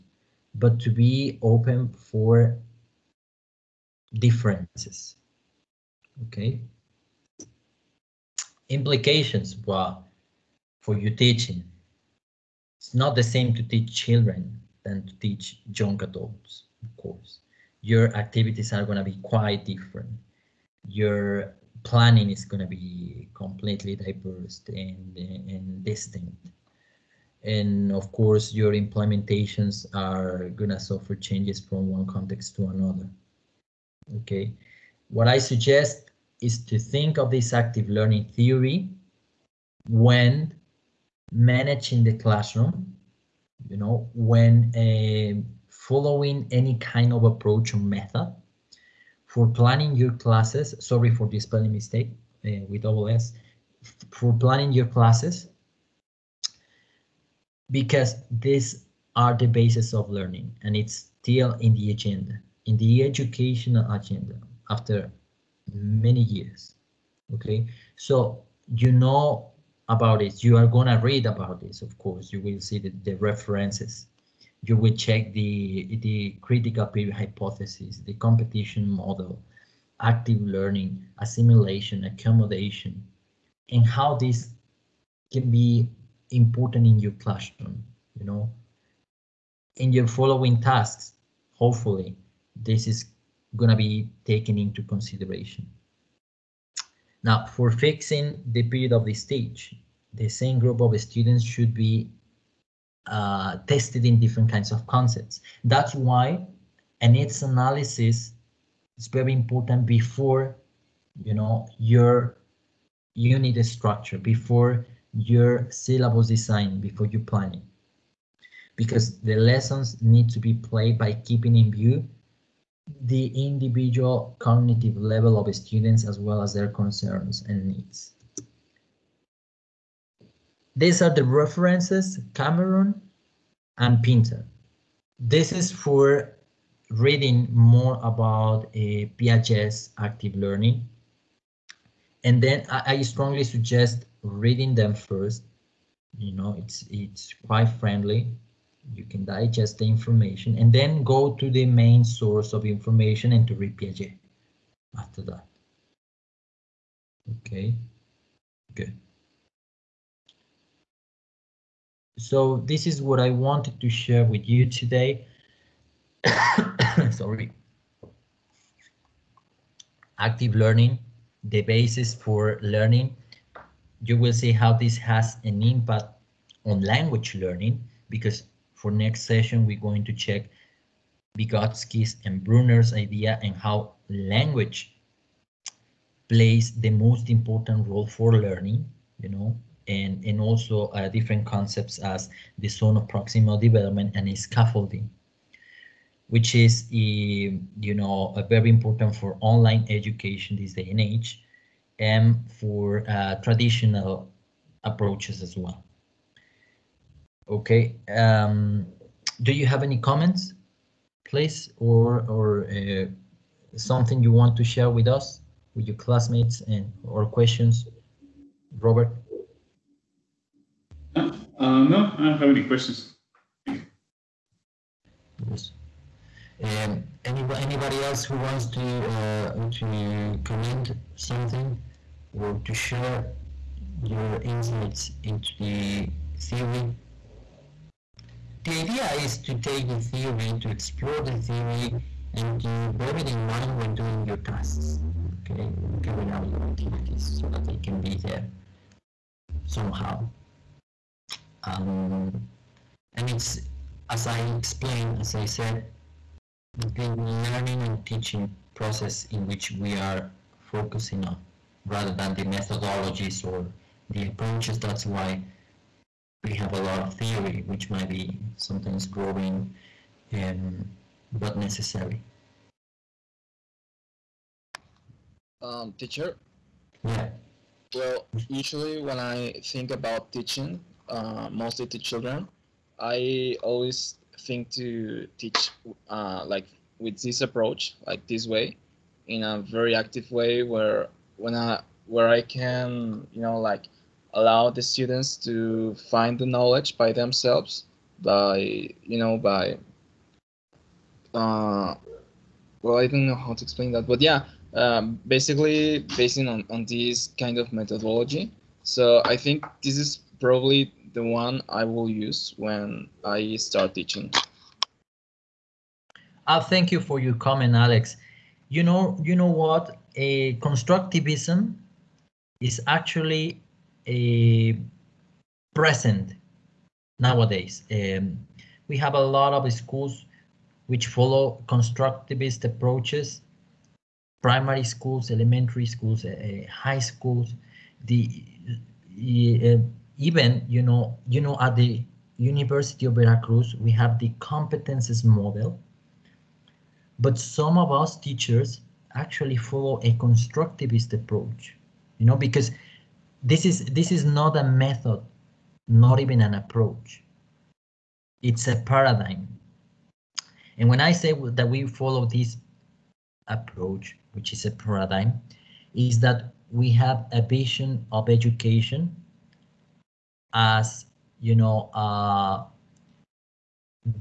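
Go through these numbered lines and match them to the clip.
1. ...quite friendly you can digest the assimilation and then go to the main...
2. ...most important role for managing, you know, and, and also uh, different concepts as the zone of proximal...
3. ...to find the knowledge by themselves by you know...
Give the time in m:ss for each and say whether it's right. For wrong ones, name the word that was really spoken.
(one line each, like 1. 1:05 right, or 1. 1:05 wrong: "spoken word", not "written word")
1. 2:27 wrong: "information", not "assimilation"
2. 3:06 wrong: "learning", not "managing"
3. 4:55 right.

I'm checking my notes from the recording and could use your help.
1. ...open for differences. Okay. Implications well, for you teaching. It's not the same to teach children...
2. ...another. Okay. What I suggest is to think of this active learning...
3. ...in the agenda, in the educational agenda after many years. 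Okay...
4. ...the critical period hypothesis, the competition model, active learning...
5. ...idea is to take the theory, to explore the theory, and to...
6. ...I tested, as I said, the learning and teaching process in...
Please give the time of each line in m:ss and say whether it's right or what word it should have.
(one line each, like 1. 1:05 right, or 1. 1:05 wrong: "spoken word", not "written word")
1. 0:01 right
2. 0:32 right
3. 1:01 right
4. 1:16 right
5. 3:58 right
6. 4:14 wrong: "explained", not "tested".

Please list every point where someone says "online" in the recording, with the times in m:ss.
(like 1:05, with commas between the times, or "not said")
3:19.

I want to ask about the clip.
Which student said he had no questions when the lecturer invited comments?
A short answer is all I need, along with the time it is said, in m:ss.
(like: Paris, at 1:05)
Robert, at 3:38.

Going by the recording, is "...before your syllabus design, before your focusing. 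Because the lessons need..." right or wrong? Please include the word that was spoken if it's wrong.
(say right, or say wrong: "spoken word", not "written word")
wrong: "planning", not "focusing".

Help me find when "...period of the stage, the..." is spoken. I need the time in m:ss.
1:38.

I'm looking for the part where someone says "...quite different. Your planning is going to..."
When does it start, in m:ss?
0:19.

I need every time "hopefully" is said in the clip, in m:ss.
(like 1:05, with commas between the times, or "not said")
1:31.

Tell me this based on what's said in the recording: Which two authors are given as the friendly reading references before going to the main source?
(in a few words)
Cameron and Pinter.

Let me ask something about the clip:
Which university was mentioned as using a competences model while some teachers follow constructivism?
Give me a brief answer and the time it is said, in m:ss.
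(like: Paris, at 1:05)
University of Veracruz, at 5:42.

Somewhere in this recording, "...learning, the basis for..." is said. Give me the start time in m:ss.
2:50.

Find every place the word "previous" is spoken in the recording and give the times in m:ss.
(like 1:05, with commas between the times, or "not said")
not said.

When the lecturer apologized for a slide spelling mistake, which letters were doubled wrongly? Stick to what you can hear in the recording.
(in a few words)
double S.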